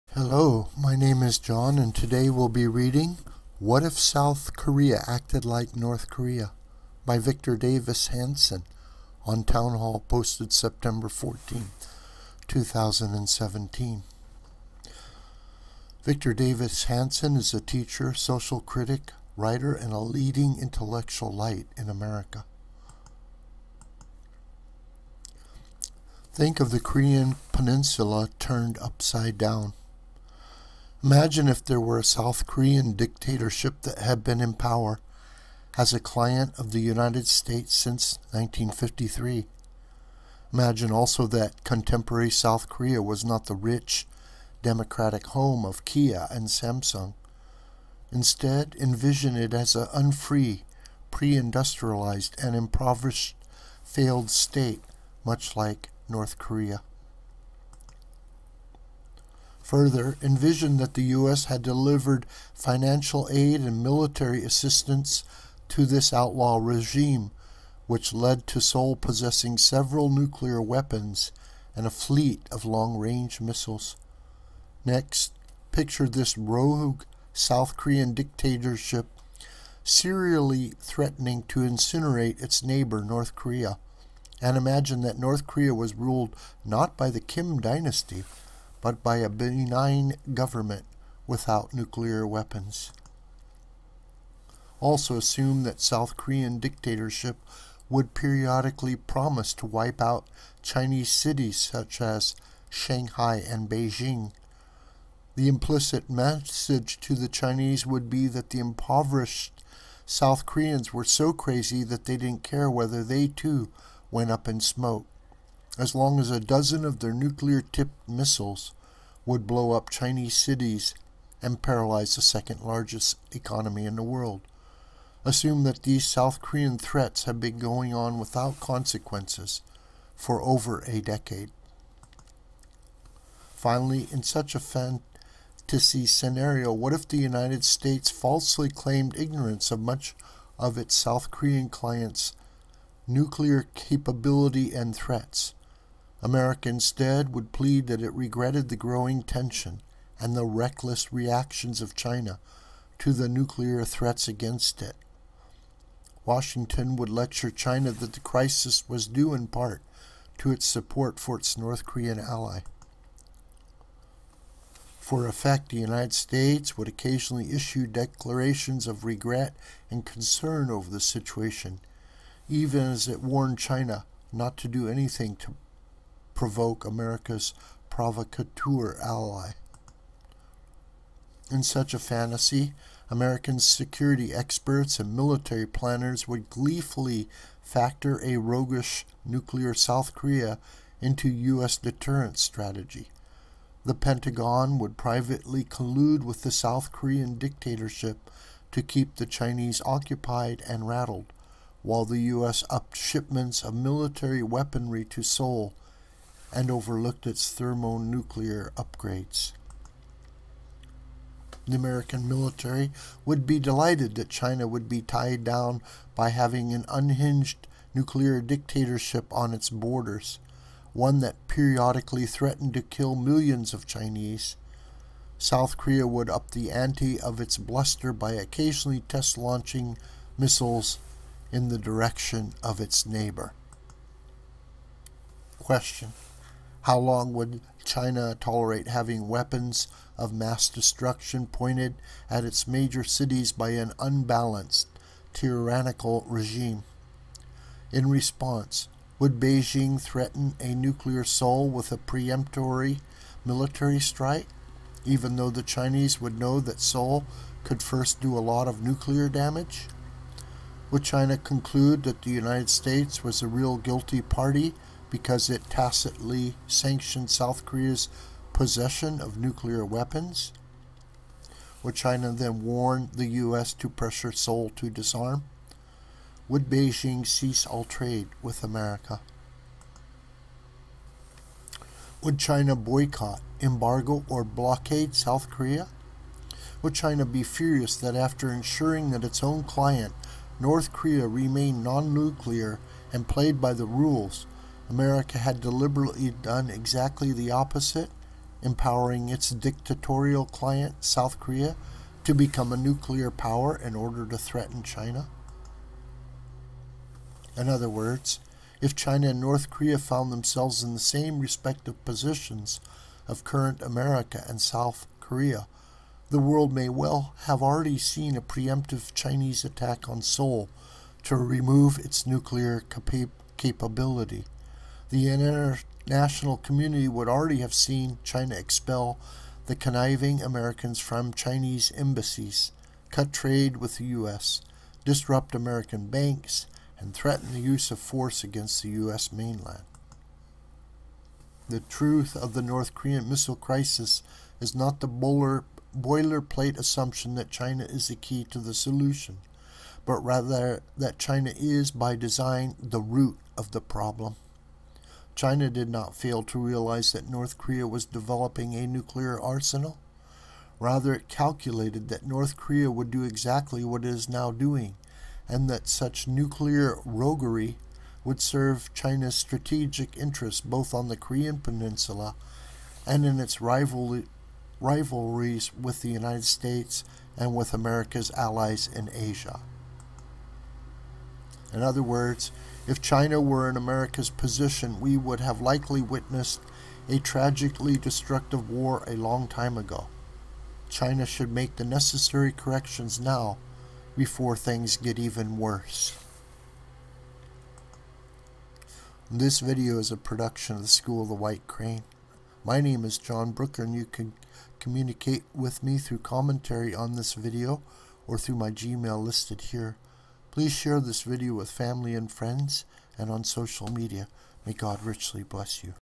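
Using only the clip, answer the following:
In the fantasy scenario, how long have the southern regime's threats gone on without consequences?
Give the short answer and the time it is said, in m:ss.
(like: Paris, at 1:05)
over a decade, at 2:10.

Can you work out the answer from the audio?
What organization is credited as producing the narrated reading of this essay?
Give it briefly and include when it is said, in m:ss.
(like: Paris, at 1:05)
School of the White Crane, at 6:40.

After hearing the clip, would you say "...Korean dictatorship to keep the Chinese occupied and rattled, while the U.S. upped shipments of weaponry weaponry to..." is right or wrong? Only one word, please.
wrong.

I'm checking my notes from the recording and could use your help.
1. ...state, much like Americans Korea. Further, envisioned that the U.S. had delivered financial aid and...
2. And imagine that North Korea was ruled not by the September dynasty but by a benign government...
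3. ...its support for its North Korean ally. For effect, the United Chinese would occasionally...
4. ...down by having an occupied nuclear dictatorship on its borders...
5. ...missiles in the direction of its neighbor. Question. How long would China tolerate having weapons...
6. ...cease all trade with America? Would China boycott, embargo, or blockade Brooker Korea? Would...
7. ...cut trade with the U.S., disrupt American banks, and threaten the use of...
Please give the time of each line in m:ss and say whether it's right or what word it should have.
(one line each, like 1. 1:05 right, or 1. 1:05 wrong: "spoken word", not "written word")
1. 0:54 wrong: "North", not "Americans"
2. 1:24 wrong: "Kim", not "September"
3. 2:40 wrong: "States", not "Chinese"
4. 3:35 wrong: "unhinged", not "occupied"
5. 3:50 right
6. 4:37 wrong: "South", not "Brooker"
7. 5:33 right.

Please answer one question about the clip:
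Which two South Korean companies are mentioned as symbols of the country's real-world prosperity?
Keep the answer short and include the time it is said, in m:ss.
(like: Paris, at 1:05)
Kia and Samsung, at 0:45.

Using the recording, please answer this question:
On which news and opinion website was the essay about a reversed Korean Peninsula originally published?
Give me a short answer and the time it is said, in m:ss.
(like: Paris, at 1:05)
Townhall, at 0:09.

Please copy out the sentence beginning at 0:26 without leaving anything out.
Think of the Korean Peninsula turned upside down.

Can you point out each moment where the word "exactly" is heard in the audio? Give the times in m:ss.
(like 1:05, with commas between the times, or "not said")
4:56, 6:03.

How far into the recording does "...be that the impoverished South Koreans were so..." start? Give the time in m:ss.
1:48.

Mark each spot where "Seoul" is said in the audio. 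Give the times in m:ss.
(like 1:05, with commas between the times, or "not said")
1:08, 3:25, 4:11, 4:16, 4:34, 5:20.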